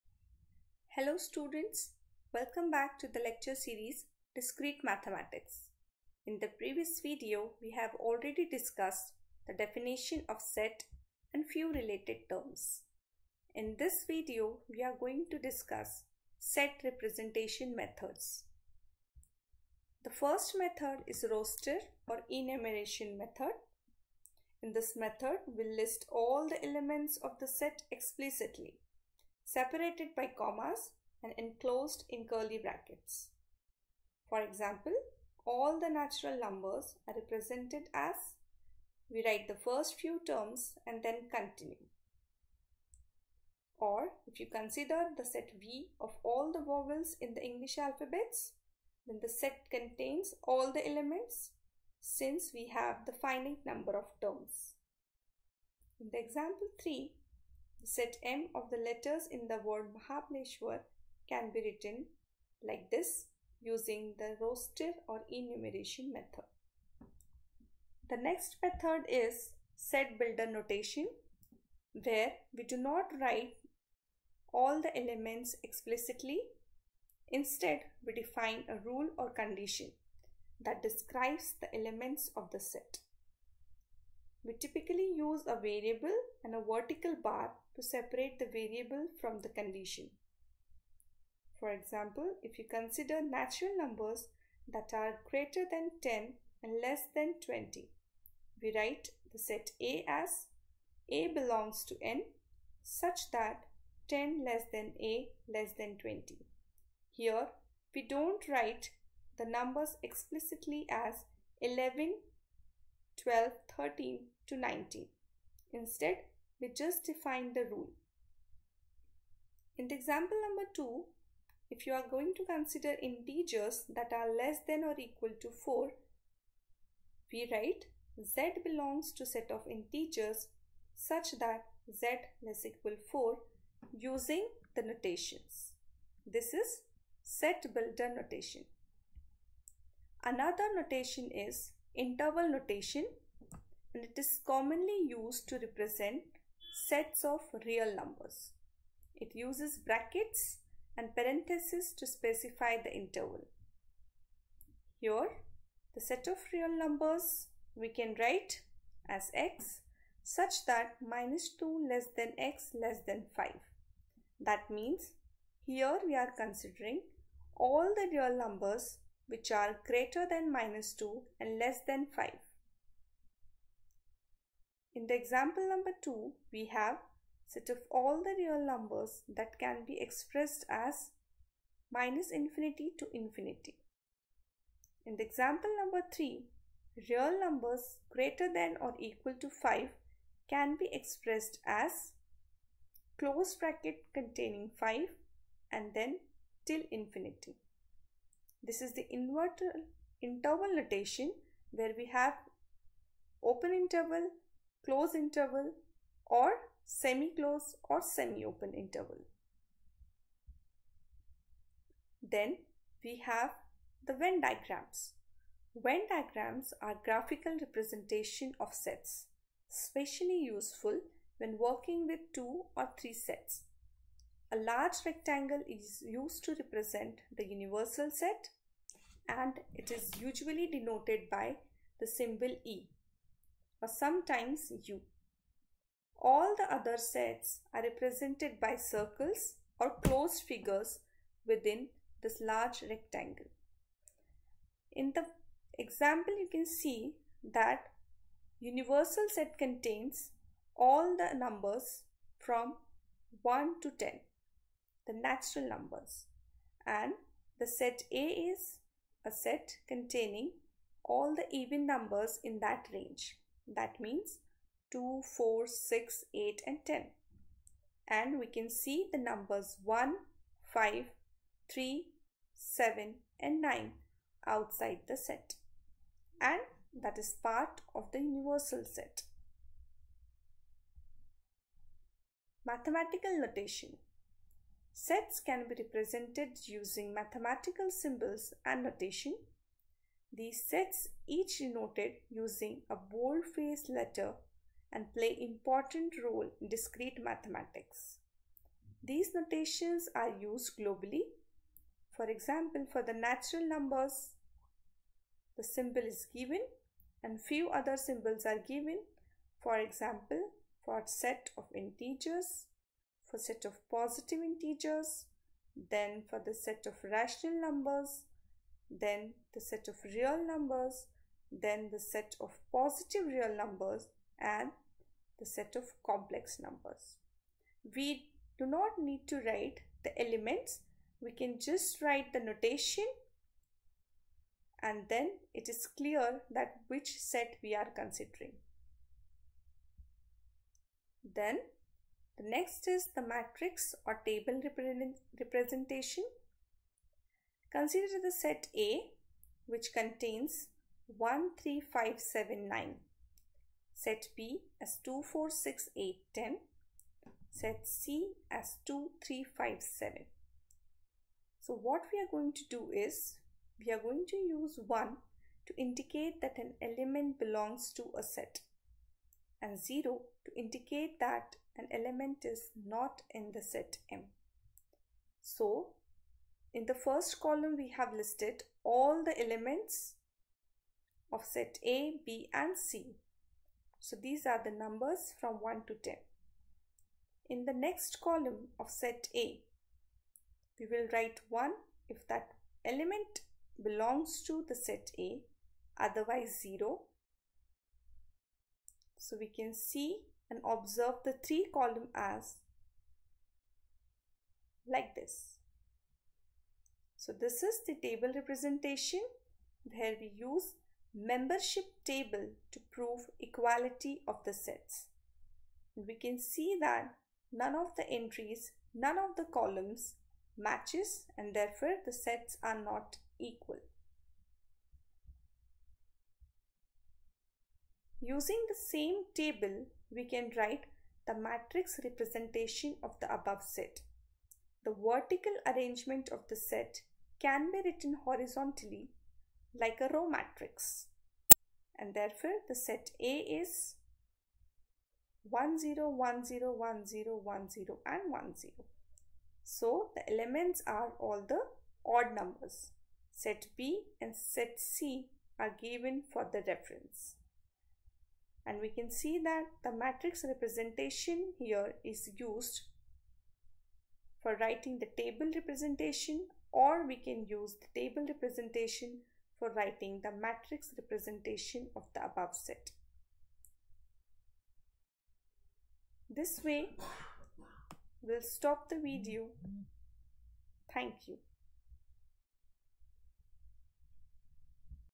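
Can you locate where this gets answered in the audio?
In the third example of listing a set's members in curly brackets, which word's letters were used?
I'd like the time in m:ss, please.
0:59.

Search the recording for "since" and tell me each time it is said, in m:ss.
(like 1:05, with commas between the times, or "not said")
0:51.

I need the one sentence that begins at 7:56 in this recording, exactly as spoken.
This way, we'll stop the video.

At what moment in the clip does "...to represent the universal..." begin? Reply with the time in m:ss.
3:46.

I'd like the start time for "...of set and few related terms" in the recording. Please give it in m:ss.
0:10.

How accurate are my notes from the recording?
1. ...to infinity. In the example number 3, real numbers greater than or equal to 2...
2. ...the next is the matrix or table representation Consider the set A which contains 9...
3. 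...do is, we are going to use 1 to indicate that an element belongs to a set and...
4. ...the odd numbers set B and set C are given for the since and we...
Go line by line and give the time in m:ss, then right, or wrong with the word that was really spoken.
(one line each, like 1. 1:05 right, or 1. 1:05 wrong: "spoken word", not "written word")
1. 3:02 wrong: "5", not "2"
2. 5:42 wrong: "1", not "9"
3. 6:02 right
4. 7:31 wrong: "reference", not "since".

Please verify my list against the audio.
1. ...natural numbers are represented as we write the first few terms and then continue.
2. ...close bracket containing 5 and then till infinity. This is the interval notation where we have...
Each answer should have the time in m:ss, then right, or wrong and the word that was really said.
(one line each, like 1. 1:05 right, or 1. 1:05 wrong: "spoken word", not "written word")
1. 0:35 right
2. 3:13 right.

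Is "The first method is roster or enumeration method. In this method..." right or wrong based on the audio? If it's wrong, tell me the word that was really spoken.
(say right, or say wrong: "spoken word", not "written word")
right.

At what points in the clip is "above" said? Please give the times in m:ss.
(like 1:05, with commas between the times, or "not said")
7:13, 7:52.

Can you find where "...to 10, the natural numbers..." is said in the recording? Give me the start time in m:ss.
4:13.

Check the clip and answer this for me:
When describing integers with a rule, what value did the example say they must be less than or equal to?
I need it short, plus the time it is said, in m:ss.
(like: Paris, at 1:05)
4, at 2:12.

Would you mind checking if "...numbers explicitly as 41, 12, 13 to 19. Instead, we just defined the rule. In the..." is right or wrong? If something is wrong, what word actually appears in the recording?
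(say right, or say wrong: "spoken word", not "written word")
wrong: "11", not "41".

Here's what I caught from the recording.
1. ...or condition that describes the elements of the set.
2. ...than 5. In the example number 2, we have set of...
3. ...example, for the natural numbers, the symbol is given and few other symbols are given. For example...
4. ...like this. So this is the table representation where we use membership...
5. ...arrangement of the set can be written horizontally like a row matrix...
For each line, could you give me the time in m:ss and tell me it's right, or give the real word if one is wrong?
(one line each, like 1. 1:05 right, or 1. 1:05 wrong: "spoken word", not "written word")
1. 1:19 right
2. 2:51 right
3. 5:02 right
4. 6:44 right
5. 7:15 right.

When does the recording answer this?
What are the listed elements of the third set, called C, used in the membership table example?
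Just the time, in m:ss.
5:58.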